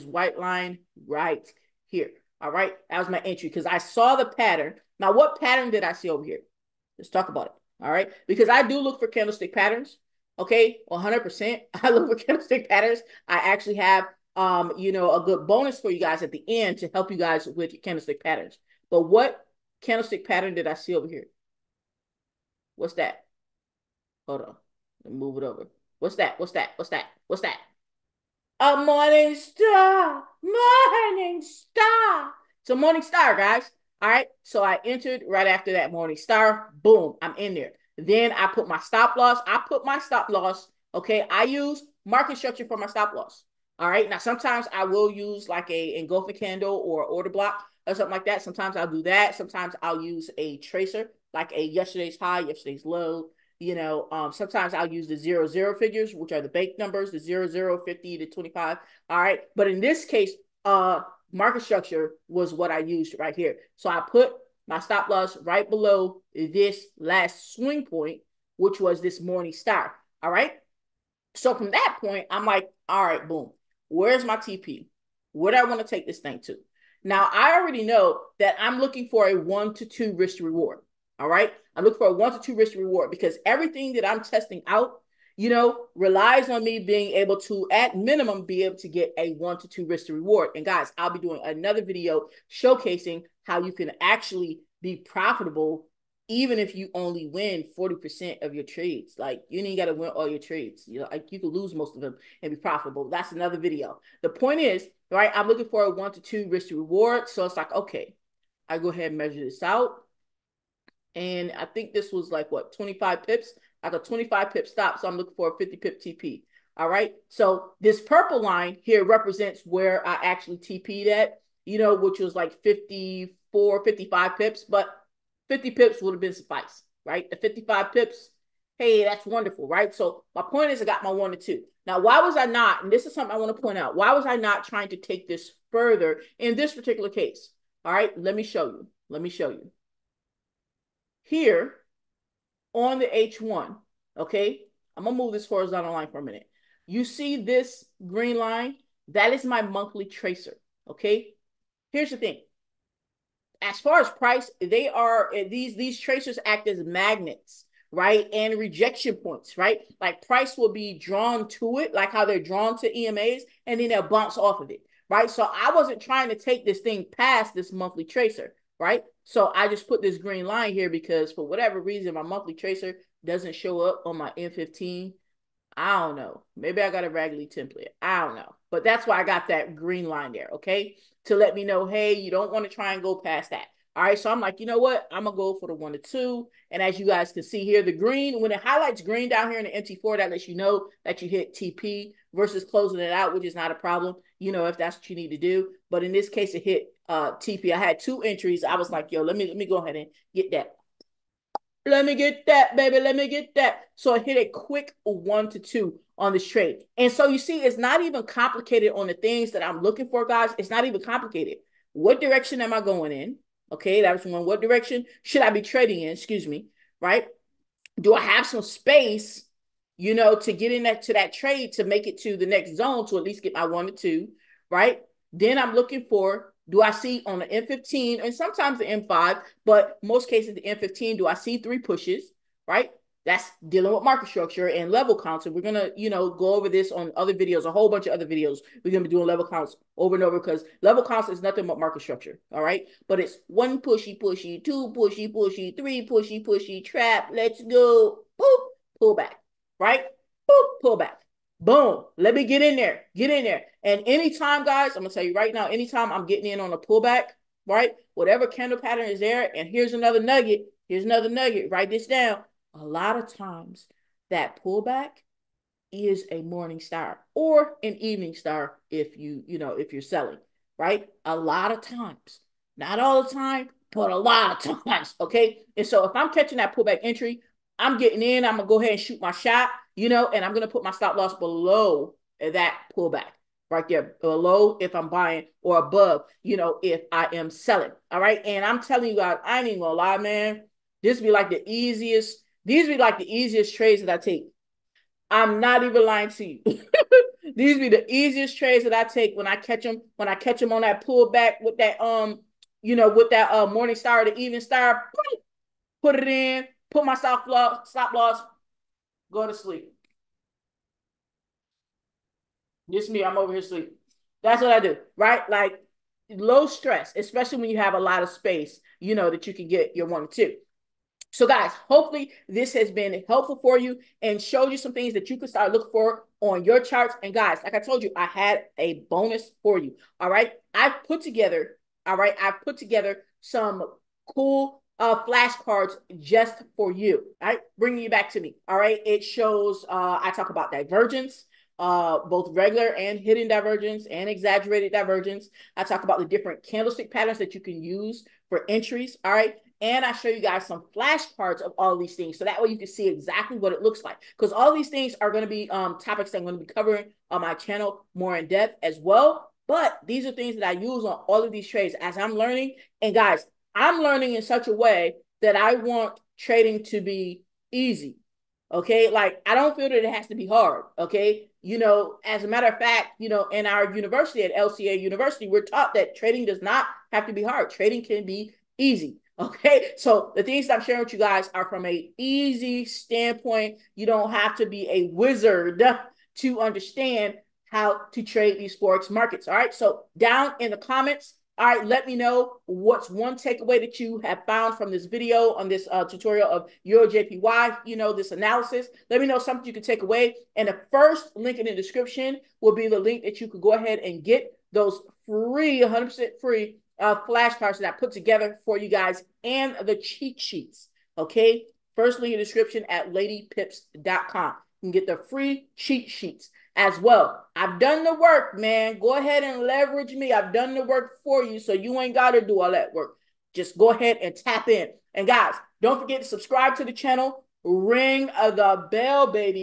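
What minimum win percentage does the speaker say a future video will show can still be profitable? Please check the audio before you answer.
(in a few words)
40%.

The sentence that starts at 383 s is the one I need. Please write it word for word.
You don't have to be a wizard to understand how to trade these forex markets.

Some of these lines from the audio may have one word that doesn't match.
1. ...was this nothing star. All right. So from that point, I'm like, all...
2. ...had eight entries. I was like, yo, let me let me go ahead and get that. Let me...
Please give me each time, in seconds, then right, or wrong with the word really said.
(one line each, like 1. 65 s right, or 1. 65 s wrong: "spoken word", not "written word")
1. 68 s wrong: "morning", not "nothing"
2. 197 s wrong: "two", not "eight".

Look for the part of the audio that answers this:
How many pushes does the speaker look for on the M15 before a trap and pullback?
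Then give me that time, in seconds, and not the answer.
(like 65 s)
231 s.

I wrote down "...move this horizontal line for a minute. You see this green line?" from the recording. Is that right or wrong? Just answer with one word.
right.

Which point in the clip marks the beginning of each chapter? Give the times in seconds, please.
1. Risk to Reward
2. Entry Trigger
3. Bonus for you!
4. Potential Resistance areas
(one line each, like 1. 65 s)
1. 80 s
2. 27 s
3. 332 s
4. 166 s.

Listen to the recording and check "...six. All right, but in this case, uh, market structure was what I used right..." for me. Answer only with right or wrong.
wrong.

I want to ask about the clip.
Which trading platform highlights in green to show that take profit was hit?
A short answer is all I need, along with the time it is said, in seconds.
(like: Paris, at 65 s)
MT4, at 189 s.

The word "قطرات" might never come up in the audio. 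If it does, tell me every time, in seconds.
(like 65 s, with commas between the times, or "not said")
not said.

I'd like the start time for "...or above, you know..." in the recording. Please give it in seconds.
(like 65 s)
285 s.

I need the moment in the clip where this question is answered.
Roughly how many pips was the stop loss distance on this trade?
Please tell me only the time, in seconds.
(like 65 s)
113 s.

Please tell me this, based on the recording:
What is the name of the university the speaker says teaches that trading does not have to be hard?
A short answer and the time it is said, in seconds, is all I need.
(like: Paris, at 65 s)
LCA University, at 374 s.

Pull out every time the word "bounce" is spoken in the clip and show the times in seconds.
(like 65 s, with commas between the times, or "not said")
164 s.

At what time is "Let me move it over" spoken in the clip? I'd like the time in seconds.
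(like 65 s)
25 s.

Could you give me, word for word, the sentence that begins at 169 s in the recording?
So I just put this green line here because for whatever reason, my monthly tracer doesn't show up on my M15.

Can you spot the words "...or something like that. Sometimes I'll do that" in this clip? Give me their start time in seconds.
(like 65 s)
47 s.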